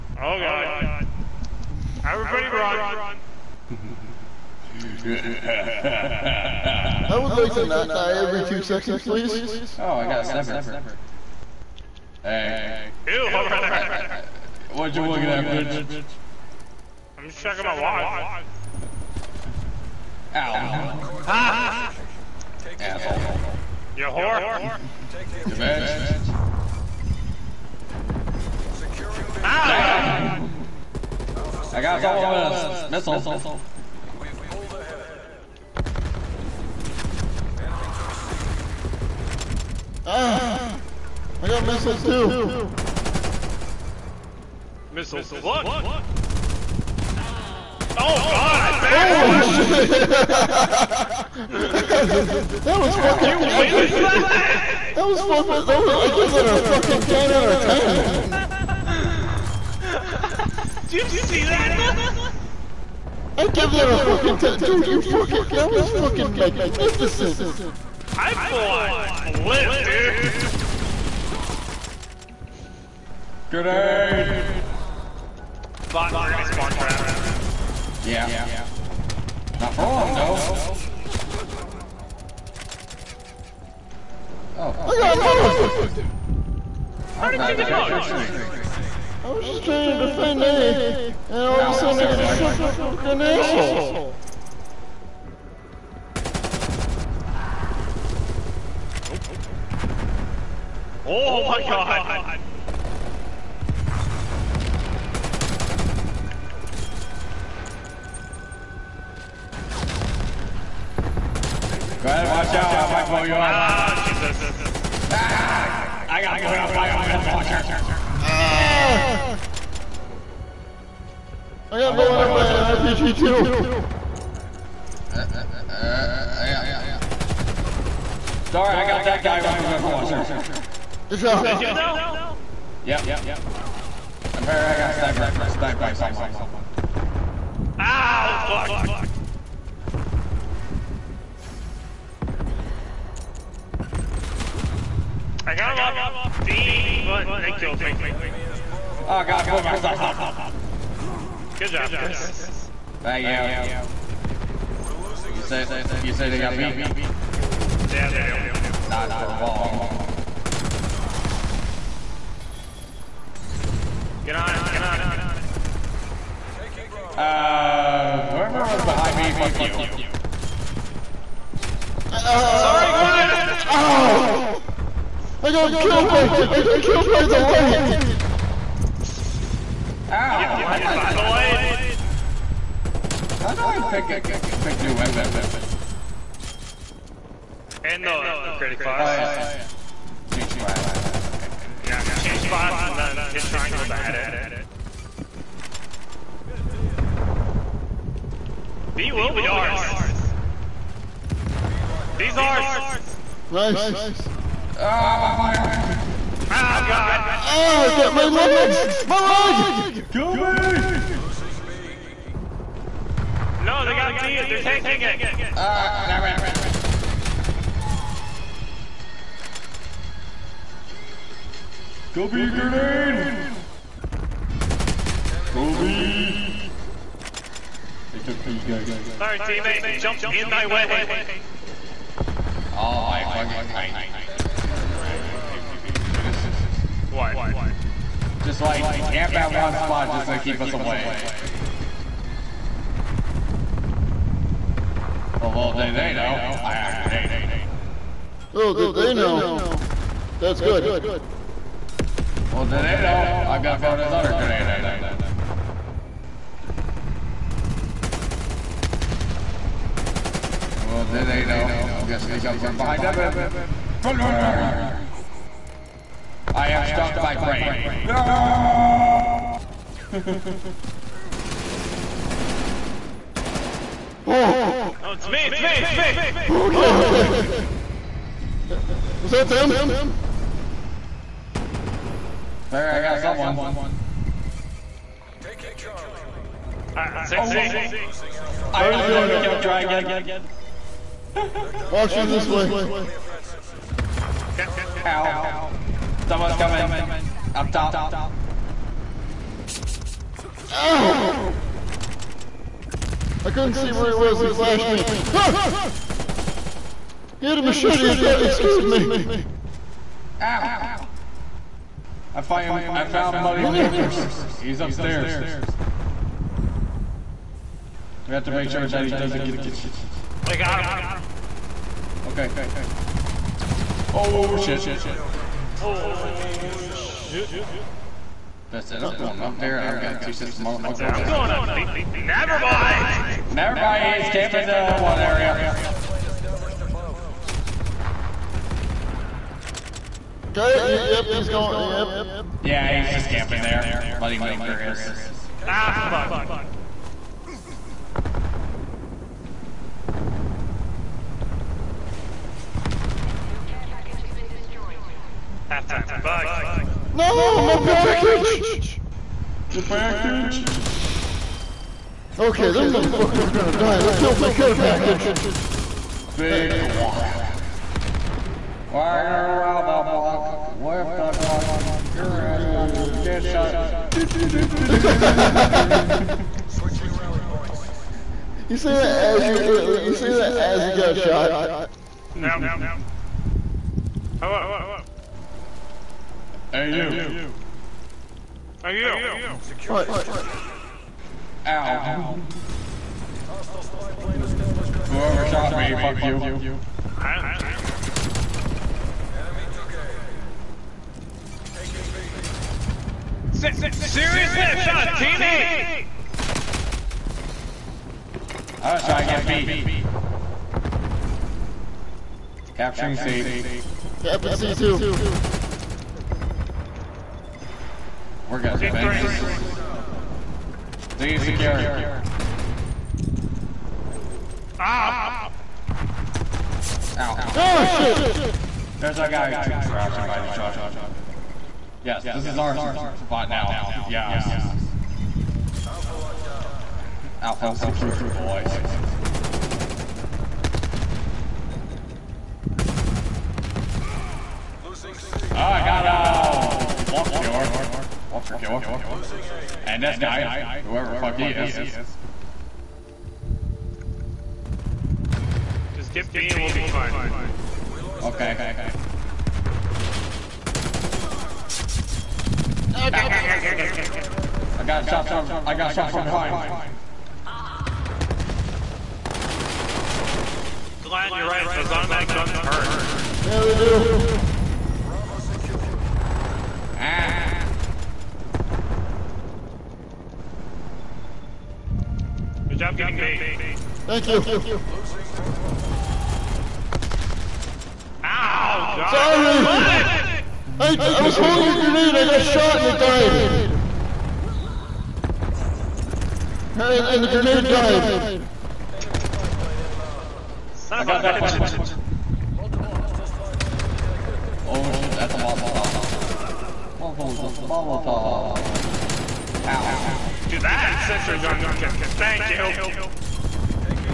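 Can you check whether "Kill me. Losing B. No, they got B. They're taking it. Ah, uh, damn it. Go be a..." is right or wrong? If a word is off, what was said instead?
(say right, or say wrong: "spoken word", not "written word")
right.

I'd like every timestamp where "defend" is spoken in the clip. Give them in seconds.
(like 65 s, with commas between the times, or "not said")
90 s.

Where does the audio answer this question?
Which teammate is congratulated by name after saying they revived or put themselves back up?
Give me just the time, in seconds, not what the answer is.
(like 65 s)
151 s.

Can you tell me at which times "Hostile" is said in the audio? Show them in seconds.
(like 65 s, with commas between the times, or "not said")
393 s.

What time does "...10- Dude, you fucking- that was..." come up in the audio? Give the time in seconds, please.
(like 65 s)
64 s.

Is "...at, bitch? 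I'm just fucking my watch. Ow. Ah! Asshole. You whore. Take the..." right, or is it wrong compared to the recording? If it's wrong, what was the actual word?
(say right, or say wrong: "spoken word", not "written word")
wrong: "checking", not "fucking".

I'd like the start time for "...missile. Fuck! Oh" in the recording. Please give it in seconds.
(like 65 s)
44 s.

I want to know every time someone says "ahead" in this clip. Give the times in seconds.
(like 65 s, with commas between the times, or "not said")
34 s, 112 s.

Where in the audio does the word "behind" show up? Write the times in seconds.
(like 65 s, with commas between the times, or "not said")
168 s, 262 s, 466 s.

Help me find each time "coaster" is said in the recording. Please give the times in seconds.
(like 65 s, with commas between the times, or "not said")
not said.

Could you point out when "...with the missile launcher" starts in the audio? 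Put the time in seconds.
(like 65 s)
129 s.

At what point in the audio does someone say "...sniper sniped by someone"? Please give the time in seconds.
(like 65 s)
134 s.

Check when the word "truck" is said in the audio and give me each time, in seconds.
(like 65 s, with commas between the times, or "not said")
430 s.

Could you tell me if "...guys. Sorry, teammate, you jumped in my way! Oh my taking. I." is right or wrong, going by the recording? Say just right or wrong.
wrong.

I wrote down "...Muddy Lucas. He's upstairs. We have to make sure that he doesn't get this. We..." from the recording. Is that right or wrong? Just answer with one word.
right.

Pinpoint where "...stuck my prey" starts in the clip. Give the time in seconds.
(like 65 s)
266 s.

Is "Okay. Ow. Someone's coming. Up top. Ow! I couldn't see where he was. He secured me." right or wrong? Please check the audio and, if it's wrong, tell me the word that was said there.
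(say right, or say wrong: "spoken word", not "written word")
wrong: "flashed", not "secured".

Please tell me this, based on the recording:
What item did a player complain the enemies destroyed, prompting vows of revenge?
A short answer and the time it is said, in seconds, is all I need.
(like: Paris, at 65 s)
Care package, at 364 s.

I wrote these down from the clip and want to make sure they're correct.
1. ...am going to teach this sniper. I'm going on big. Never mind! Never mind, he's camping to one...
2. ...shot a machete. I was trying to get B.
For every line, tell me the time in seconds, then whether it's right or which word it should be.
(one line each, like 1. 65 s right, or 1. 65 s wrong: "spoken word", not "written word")
1. 329 s wrong: "motherfucker", not "sniper"
2. 404 s wrong: "teammate", not "machete".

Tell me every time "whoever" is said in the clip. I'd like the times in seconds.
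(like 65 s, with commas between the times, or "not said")
168 s, 395 s, 450 s.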